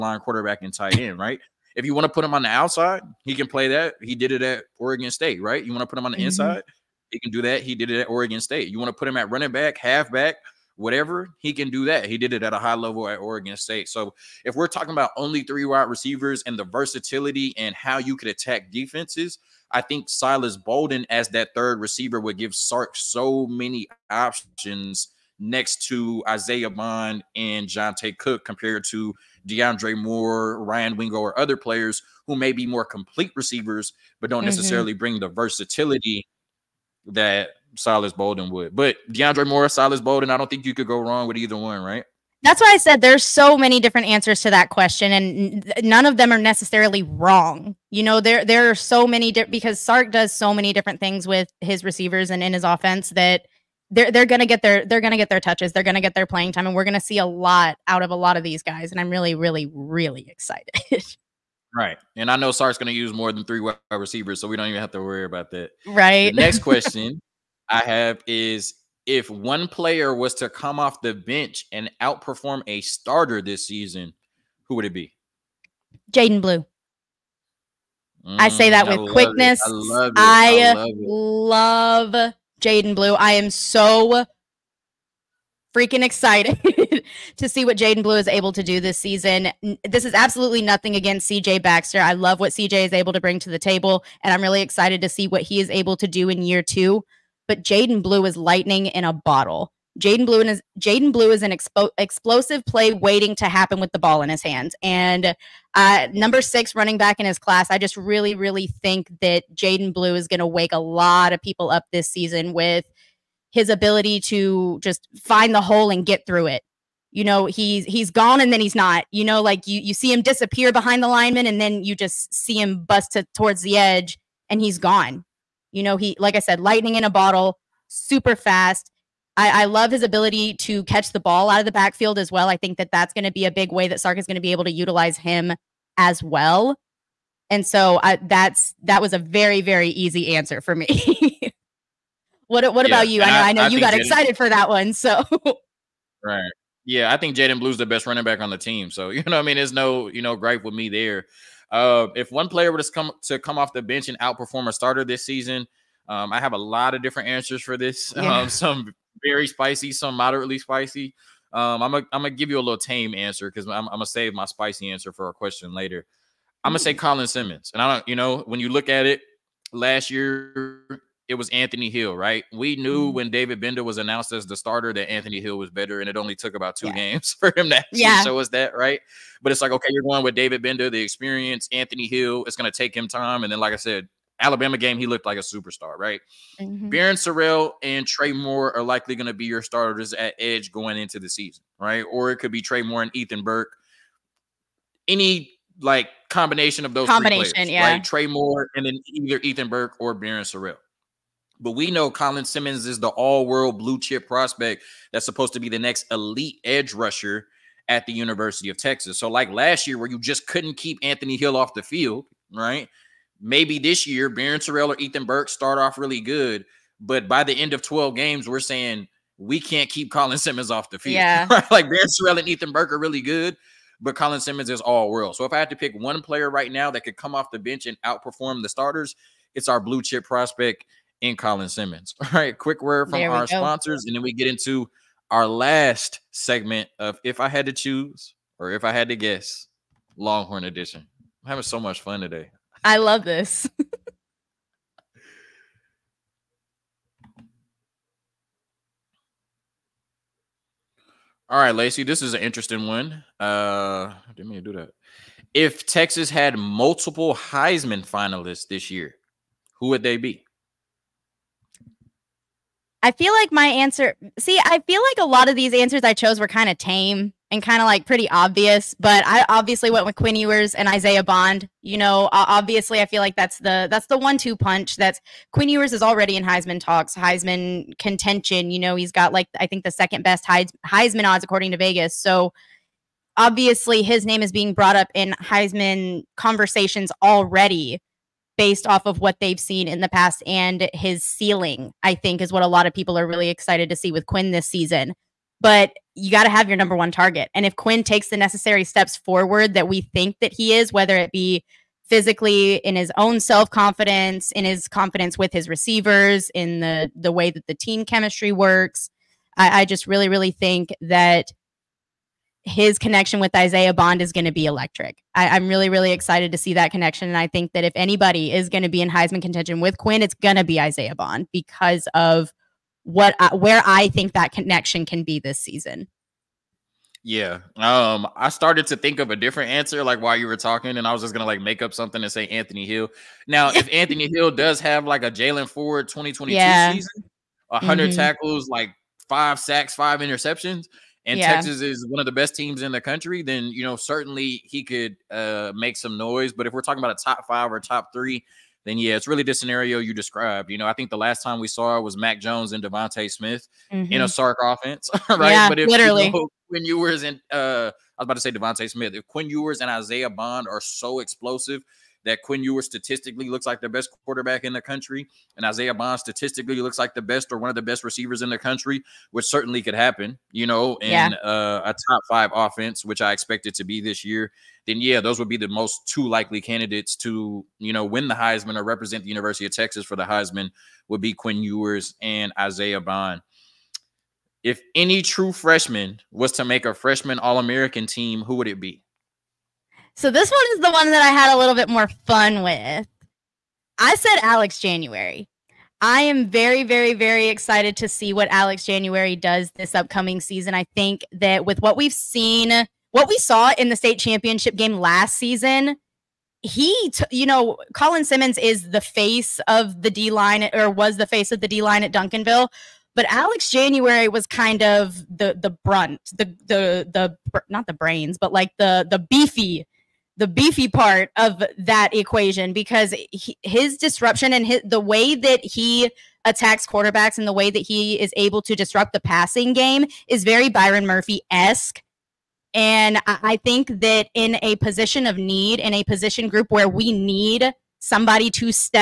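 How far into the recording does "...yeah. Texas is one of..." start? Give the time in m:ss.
5:41.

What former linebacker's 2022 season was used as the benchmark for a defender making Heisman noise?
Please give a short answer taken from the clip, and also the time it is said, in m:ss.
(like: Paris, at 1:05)
Jaylan Ford, at 5:35.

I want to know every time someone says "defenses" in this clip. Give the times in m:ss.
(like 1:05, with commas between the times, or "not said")
0:18.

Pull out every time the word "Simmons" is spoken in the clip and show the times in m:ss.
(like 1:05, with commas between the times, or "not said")
2:47, 3:22, 3:40, 3:44, 3:51, 6:48.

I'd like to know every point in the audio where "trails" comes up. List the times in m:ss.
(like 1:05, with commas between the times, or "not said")
not said.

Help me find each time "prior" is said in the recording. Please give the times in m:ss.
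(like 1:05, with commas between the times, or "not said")
not said.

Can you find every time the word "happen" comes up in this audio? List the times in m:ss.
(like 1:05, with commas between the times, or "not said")
1:43, 6:09.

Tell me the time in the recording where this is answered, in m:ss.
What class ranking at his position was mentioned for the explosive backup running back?
1:46.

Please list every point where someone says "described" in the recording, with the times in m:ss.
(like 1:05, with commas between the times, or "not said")
5:50.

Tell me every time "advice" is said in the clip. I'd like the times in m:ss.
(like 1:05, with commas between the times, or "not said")
not said.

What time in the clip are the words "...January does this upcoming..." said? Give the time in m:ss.
6:38.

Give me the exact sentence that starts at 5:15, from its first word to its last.
I, am really, really excited to see that connection.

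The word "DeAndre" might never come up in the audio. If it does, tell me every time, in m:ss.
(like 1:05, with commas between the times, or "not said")
0:29, 0:39.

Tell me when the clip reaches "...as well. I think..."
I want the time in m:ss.
2:12.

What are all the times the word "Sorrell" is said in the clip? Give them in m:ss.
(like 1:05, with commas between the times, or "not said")
3:07, 3:20.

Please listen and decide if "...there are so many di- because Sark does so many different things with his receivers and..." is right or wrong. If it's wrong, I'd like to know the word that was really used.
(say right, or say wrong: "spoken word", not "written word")
right.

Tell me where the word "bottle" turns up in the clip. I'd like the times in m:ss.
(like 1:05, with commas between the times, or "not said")
1:39, 2:07.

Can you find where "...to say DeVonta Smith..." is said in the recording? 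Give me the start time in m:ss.
5:58.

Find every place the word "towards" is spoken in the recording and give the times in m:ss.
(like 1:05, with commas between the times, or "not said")
2:03.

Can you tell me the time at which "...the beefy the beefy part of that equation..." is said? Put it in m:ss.
6:59.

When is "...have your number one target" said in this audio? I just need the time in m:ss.
4:56.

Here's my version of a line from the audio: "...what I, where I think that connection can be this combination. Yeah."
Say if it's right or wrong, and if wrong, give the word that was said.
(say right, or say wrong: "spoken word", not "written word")
wrong: "season", not "combination".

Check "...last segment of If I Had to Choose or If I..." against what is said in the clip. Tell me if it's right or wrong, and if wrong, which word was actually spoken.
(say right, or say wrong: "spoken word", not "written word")
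right.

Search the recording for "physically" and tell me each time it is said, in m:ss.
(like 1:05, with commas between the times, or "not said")
5:02.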